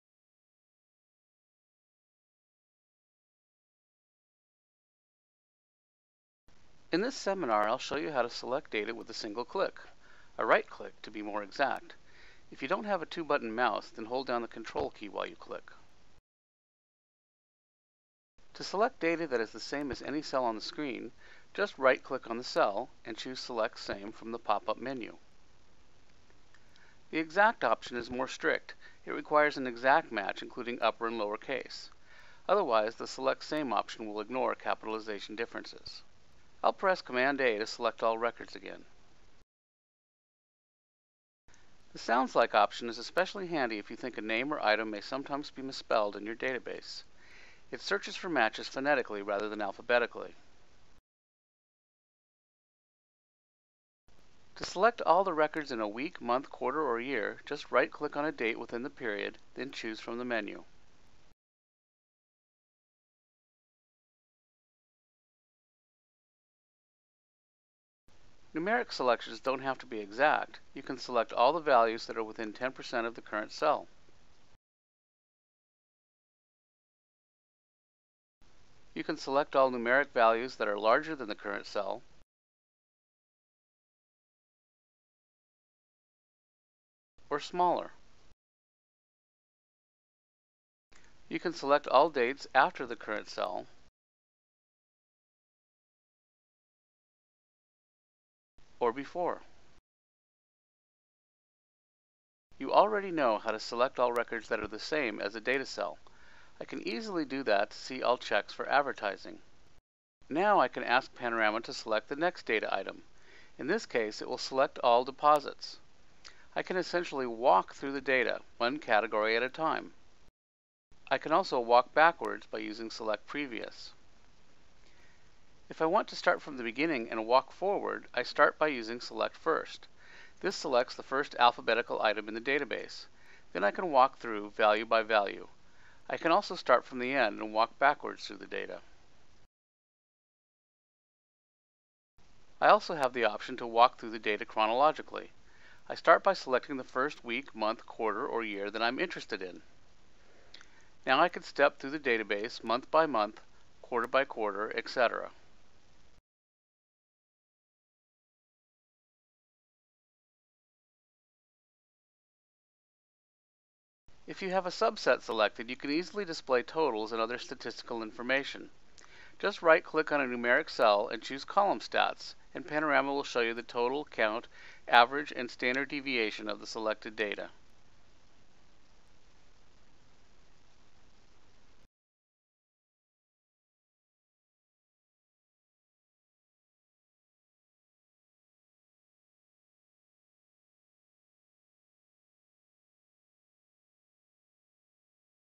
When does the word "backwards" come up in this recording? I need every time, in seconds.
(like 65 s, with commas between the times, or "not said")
121 s, 137 s.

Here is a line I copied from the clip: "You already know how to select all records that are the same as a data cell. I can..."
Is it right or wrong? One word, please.
right.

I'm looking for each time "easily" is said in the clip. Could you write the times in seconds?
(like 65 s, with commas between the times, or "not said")
106 s, 165 s.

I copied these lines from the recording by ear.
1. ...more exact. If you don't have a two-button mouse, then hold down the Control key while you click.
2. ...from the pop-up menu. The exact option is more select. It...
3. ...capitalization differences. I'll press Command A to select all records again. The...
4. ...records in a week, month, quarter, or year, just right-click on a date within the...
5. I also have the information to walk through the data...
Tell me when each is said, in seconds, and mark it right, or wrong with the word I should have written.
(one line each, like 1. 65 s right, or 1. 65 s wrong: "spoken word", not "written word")
1. 11 s right
2. 24 s wrong: "strict", not "select"
3. 34 s right
4. 55 s right
5. 142 s wrong: "option", not "information".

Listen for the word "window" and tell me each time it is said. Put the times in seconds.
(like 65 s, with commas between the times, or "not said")
not said.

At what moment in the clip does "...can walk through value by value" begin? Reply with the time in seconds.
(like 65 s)
133 s.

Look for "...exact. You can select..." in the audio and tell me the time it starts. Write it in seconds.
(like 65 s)
70 s.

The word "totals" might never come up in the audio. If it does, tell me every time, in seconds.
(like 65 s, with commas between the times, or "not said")
166 s, 173 s.